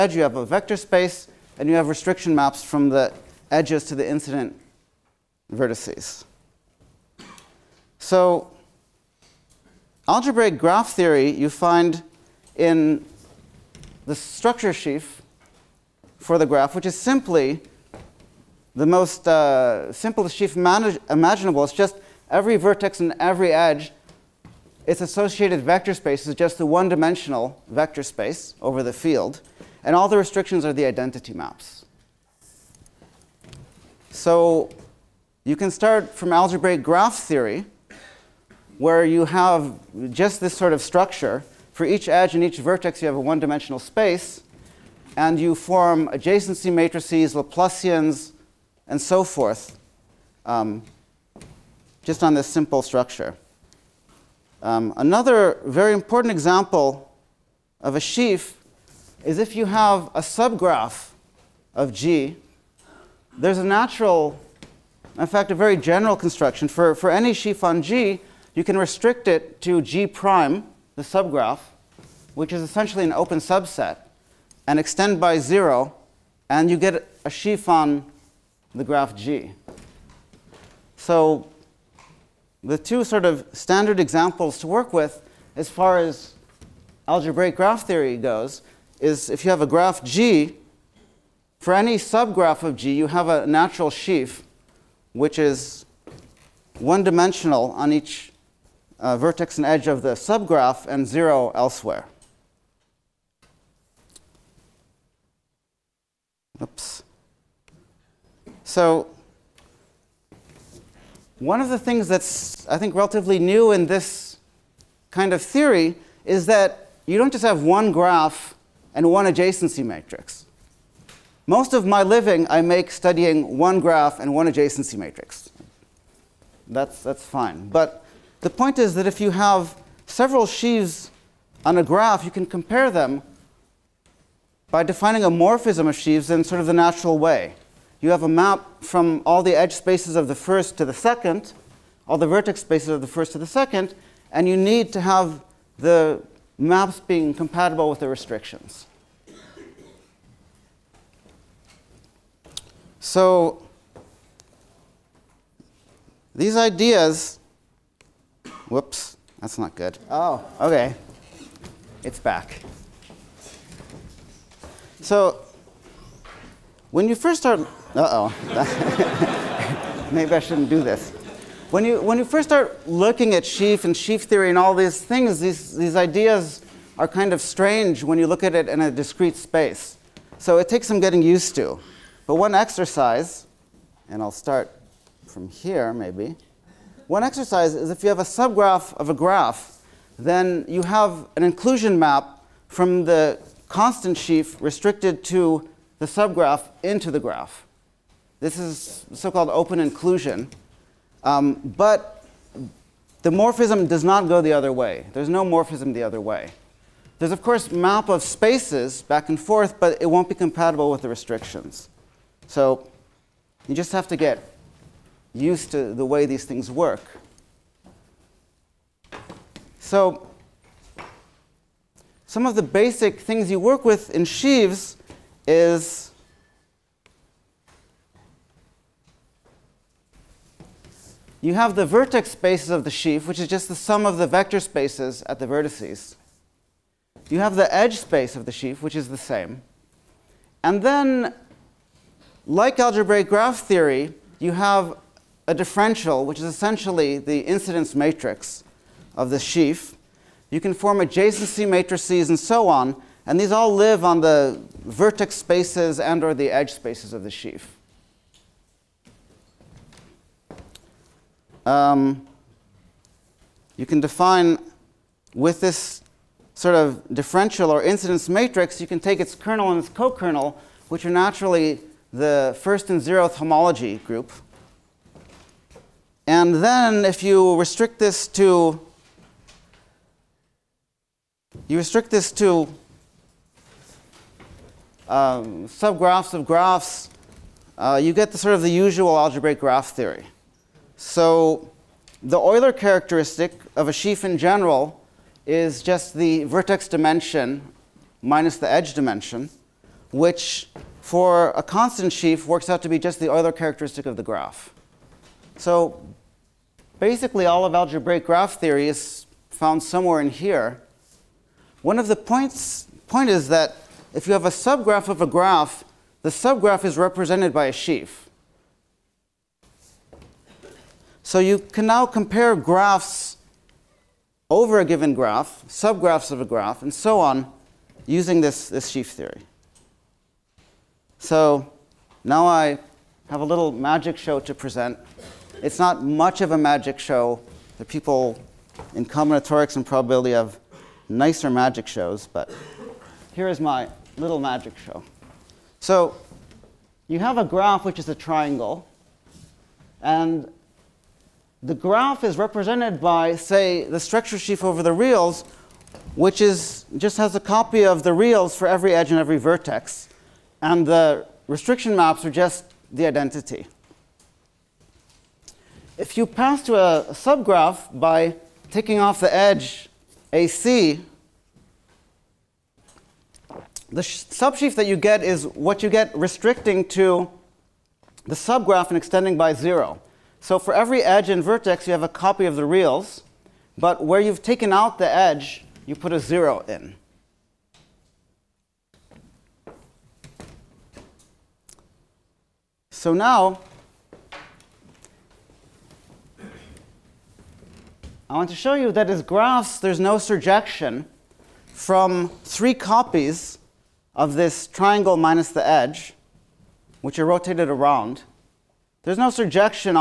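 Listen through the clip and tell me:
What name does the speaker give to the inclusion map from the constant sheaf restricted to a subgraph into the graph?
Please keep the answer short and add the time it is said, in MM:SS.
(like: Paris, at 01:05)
open inclusion, at 03:19.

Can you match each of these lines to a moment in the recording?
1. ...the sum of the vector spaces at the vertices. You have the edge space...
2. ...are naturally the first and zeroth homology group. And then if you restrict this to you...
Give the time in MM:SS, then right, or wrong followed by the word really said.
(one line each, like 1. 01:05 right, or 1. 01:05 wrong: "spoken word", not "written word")
1. 03:53 right
2. 04:31 right.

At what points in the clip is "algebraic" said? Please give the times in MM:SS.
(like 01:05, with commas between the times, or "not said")
00:10, 00:36, 01:27, 04:02, 04:49, 05:07.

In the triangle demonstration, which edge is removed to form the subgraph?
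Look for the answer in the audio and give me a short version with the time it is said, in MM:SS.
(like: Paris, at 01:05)
AC, at 06:10.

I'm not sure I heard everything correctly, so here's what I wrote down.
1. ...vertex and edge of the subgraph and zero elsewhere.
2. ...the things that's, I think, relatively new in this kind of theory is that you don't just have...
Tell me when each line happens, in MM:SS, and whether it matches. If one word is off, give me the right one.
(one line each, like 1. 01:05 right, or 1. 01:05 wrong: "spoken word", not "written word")
1. 01:39 right
2. 01:51 right.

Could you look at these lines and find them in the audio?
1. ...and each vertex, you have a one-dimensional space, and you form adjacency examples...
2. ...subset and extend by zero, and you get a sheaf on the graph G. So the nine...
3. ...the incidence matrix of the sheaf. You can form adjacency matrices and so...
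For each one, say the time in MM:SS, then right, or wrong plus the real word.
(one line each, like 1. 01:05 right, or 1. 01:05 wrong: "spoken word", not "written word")
1. 00:42 wrong: "matrices", not "examples"
2. 01:13 wrong: "two", not "nine"
3. 04:07 right.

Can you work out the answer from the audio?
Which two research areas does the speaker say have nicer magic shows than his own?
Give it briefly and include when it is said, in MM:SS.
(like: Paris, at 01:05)
combinatorics and probability, at 05:39.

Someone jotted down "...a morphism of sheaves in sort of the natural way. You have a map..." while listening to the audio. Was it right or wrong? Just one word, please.
right.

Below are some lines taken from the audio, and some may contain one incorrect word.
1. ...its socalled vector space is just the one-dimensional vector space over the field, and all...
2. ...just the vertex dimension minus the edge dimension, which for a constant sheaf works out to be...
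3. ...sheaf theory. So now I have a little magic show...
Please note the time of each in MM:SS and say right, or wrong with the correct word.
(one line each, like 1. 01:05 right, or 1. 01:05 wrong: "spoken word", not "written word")
1. 00:24 wrong: "associated", not "socalled"
2. 04:55 right
3. 05:28 right.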